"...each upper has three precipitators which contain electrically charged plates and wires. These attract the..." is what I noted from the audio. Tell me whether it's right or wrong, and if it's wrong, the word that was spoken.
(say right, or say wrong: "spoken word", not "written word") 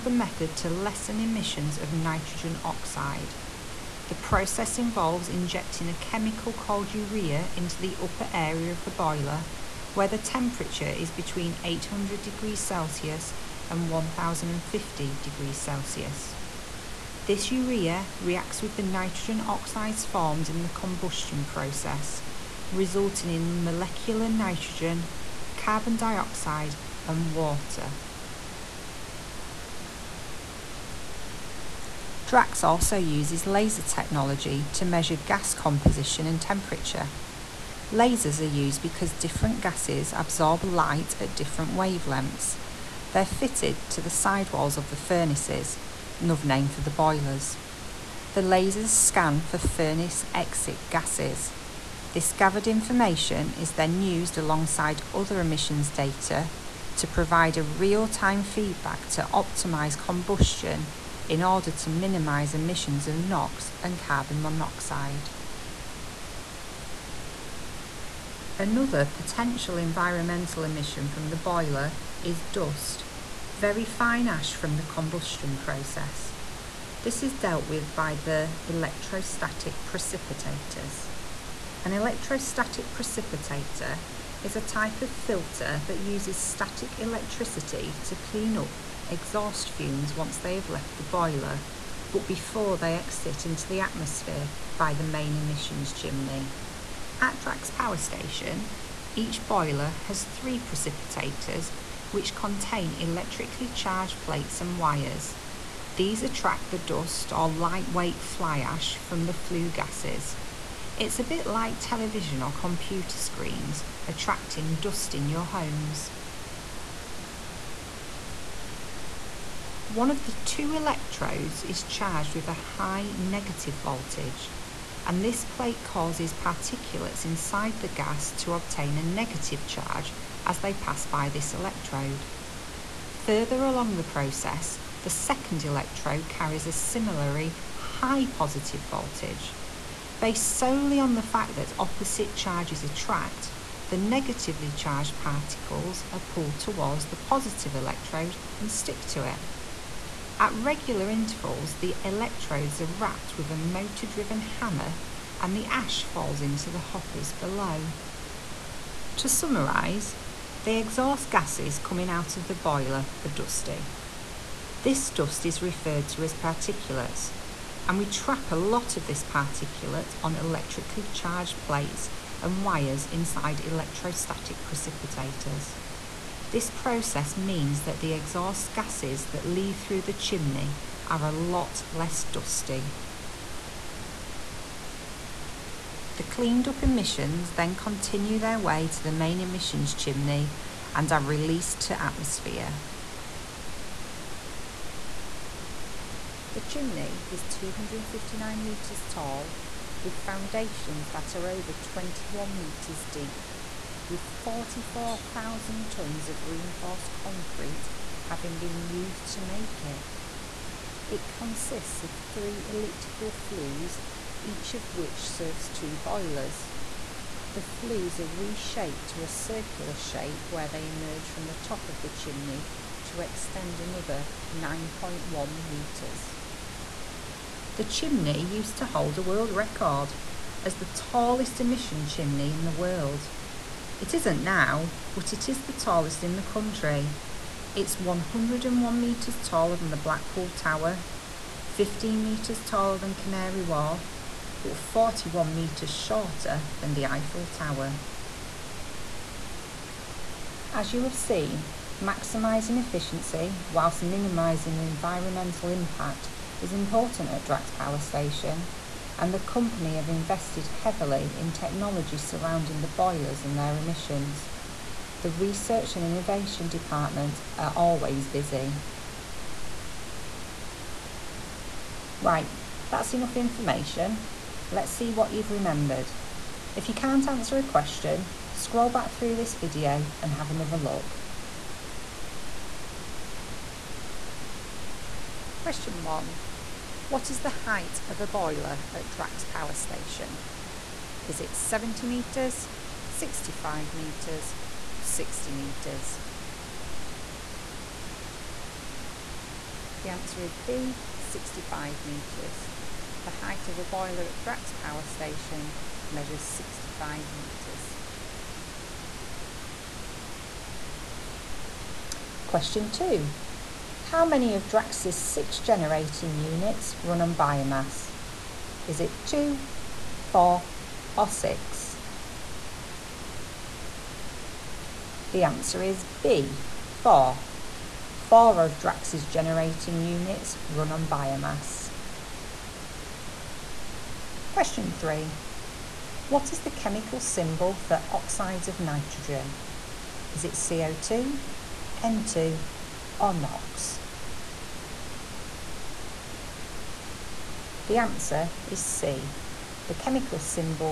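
wrong: "boiler", not "upper".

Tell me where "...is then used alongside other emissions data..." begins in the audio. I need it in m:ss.
0:53.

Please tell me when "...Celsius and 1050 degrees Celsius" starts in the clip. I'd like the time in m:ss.
0:12.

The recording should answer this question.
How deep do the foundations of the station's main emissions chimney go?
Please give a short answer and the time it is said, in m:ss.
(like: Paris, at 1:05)
over 21 metres, at 3:21.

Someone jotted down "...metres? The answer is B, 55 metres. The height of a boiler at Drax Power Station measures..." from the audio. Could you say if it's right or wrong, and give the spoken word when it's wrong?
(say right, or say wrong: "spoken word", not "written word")
wrong: "65", not "55".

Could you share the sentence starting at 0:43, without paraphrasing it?
They're fitted to the sidewalls of the furnaces, another name for the boilers.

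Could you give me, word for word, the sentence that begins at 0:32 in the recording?
Drax also uses laser technology to measure gas composition and temperature.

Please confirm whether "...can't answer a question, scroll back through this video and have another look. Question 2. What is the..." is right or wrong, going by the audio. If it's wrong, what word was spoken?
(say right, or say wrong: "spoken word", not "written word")
wrong: "1", not "2".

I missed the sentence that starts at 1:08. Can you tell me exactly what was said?
Another potential environmental emission from the boiler is dust, very fine ash from the combustion process.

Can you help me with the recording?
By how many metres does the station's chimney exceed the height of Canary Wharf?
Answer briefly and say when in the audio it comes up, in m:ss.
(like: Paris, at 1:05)
15 metres, at 4:01.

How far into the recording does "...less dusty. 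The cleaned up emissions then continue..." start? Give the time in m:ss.
3:01.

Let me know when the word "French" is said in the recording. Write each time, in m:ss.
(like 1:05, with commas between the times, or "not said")
not said.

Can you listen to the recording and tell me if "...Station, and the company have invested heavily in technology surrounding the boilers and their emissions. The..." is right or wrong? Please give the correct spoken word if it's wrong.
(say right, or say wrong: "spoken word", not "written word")
right.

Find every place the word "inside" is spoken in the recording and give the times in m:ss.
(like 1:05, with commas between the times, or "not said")
2:07, 2:53.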